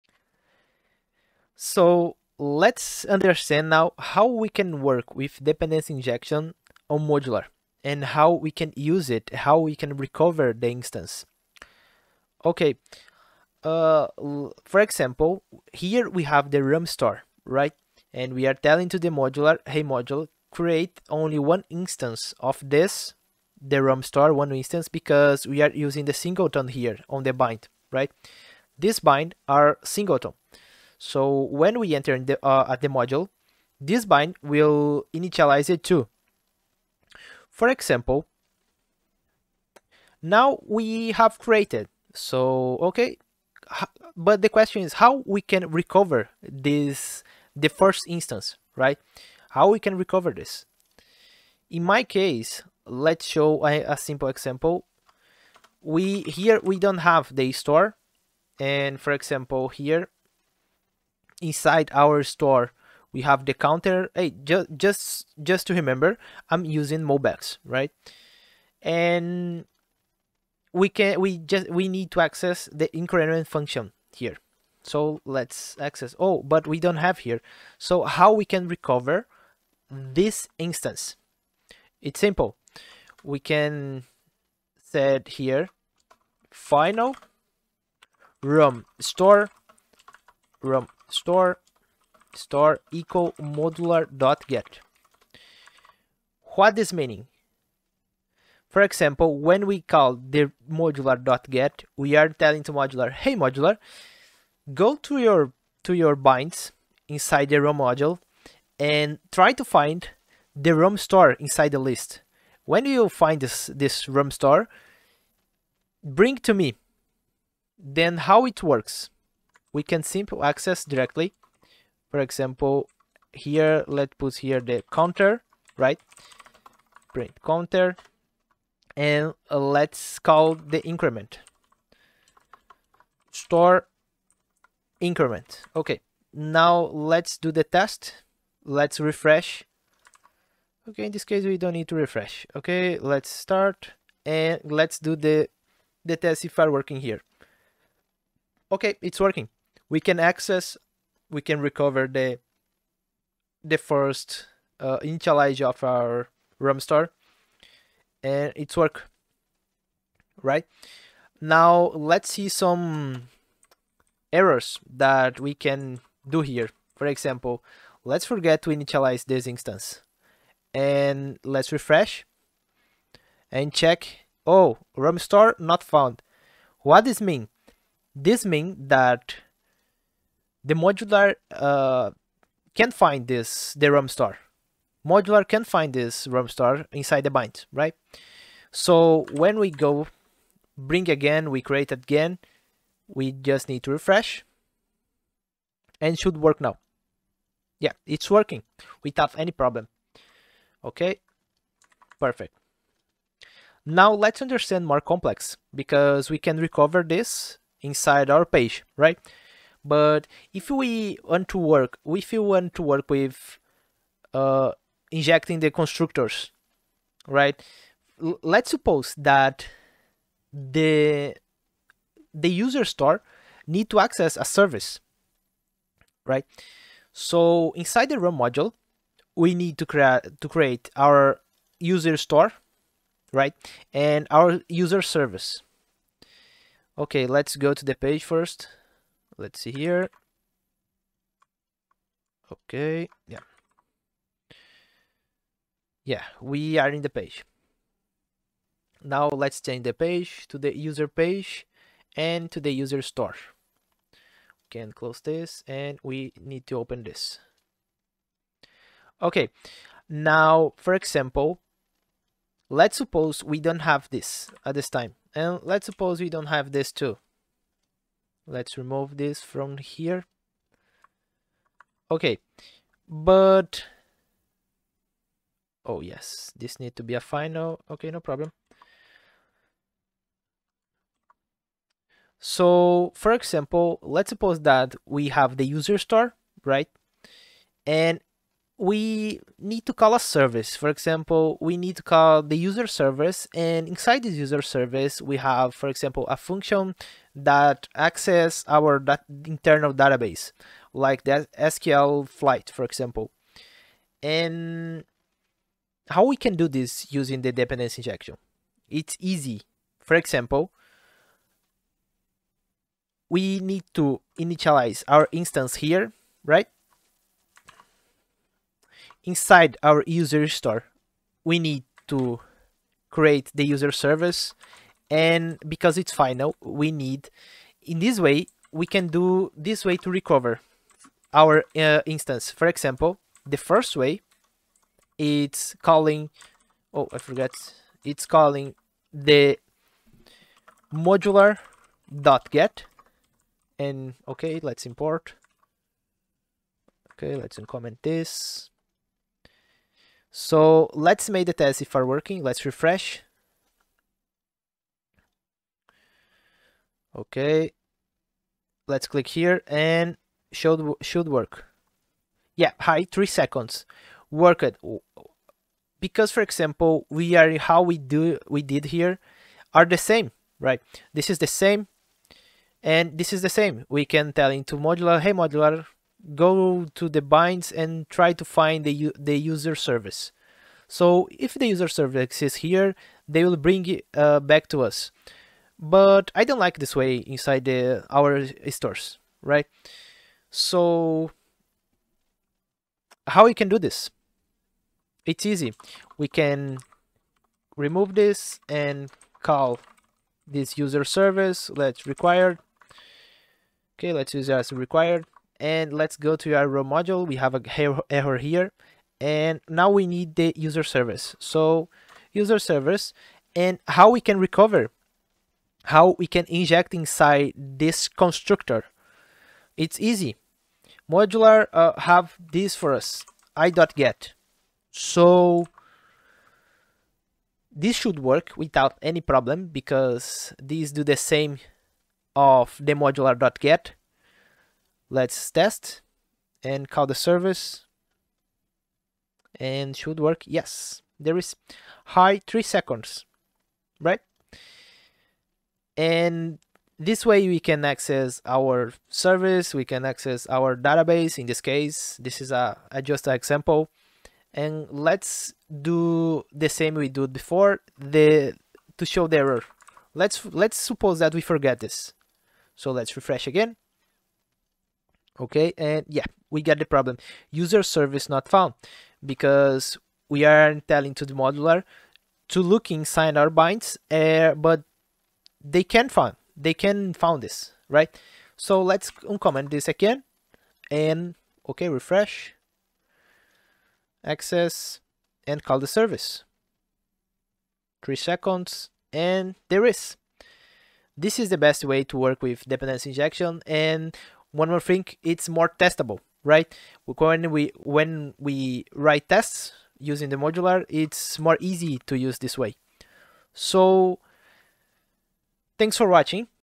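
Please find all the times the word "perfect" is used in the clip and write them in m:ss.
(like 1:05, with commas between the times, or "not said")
3:22.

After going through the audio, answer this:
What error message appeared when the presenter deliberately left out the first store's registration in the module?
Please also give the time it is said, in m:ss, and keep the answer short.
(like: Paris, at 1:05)
ROM store not found, at 2:54.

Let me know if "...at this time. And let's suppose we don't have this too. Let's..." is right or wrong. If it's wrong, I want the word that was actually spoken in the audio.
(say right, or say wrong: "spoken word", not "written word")
right.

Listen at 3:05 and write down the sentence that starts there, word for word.
Modular can find this ROM store inside the bind, right?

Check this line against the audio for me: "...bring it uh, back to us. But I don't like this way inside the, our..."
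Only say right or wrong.
right.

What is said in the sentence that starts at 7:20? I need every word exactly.
Yes, there is high three seconds, right?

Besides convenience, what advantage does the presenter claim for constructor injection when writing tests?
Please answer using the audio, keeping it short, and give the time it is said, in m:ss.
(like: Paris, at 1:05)
more testable, at 8:15.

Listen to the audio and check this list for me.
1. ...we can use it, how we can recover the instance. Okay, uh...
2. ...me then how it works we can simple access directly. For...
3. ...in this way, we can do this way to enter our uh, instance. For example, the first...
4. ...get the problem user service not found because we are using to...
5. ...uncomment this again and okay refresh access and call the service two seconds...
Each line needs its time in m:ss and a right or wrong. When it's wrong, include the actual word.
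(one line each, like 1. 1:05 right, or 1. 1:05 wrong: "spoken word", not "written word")
1. 0:08 right
2. 1:56 right
3. 5:27 wrong: "recover", not "enter"
4. 7:46 wrong: "telling", not "using"
5. 7:59 wrong: "three", not "two".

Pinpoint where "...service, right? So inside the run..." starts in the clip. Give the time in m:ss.
3:44.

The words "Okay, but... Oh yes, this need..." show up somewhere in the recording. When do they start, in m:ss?
4:32.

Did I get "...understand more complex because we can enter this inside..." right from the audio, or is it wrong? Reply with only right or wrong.
wrong.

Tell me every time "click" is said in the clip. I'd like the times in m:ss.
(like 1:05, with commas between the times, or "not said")
5:59.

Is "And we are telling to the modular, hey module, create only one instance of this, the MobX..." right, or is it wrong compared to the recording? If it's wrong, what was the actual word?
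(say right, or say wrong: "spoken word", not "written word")
wrong: "RAM", not "MobX".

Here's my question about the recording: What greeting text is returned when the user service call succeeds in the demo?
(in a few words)
hi.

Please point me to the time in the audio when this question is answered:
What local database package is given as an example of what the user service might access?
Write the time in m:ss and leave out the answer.
5:01.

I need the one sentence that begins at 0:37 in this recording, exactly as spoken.
For example, now we have created.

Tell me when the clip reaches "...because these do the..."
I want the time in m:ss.
7:09.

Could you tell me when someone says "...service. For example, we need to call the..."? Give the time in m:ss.
4:50.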